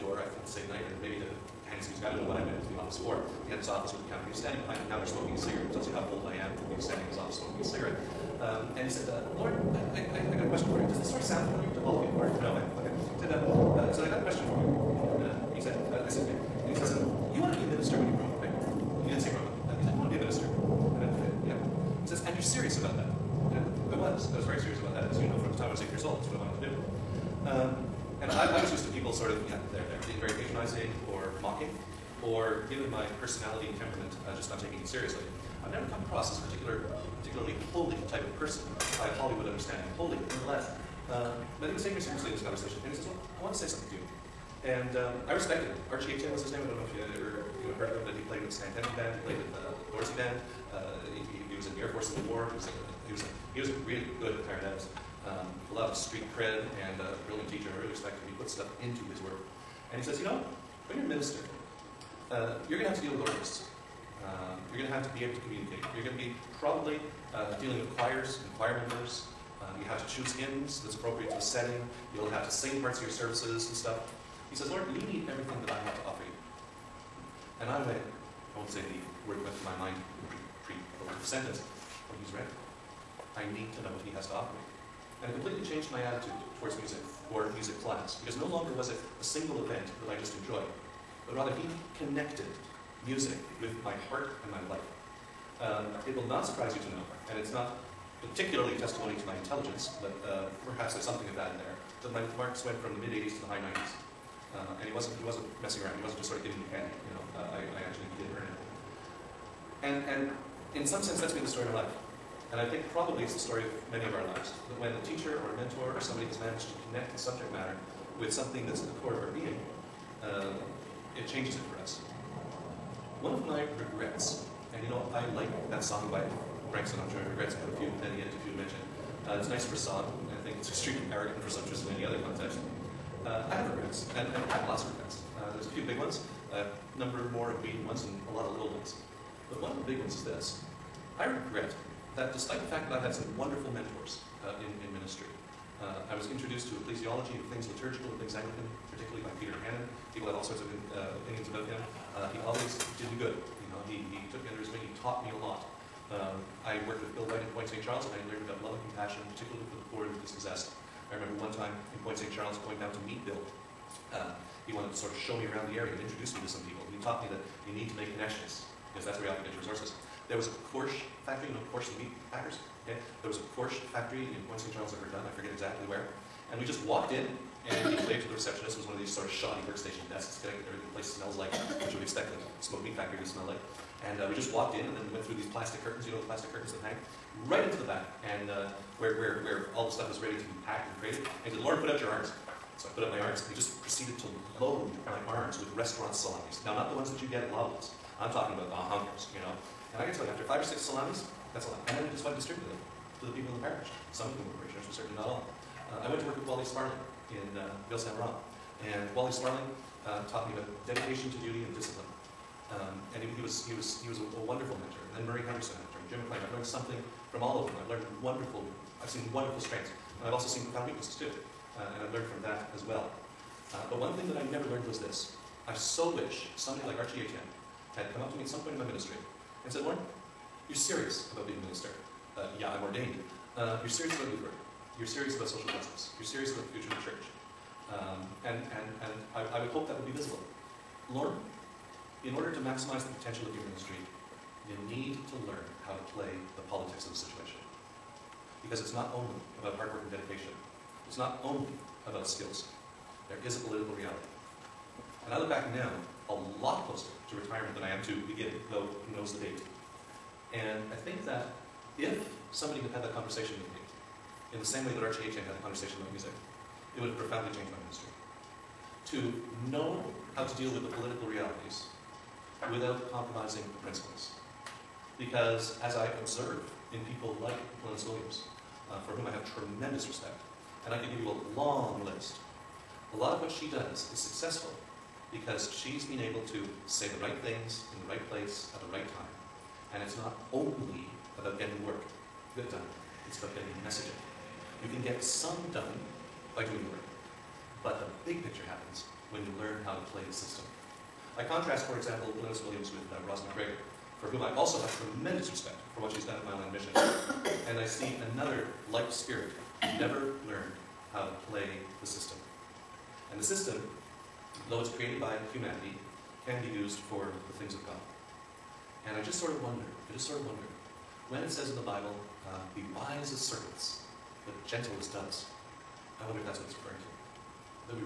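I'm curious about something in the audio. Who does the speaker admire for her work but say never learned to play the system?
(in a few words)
Ross McGregor.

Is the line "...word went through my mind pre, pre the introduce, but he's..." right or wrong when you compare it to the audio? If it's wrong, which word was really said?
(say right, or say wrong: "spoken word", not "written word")
wrong: "sentence", not "introduce".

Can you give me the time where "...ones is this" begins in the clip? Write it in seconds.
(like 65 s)
139 s.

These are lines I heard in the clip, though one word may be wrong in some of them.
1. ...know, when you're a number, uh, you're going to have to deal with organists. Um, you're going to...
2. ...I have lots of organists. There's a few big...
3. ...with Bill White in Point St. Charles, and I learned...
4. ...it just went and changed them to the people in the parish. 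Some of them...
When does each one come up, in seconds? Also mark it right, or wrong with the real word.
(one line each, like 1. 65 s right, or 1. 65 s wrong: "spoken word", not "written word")
1. 60 s wrong: "minister", not "number"
2. 134 s wrong: "regrets", not "organists"
3. 156 s right
4. 202 s wrong: "distributed", not "changed".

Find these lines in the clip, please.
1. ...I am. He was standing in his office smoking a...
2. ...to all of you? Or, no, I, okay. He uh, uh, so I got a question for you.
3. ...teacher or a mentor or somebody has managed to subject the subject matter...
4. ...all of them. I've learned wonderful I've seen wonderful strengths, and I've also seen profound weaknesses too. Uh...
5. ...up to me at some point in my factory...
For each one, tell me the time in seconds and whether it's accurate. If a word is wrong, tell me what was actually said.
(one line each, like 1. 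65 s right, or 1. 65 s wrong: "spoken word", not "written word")
1. 6 s right
2. 11 s right
3. 115 s wrong: "connect", not "subject"
4. 217 s right
5. 228 s wrong: "ministry", not "factory".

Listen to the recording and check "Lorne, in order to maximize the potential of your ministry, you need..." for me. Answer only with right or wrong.
right.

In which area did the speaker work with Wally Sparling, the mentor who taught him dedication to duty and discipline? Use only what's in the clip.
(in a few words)
Ville-Saint-Laurent.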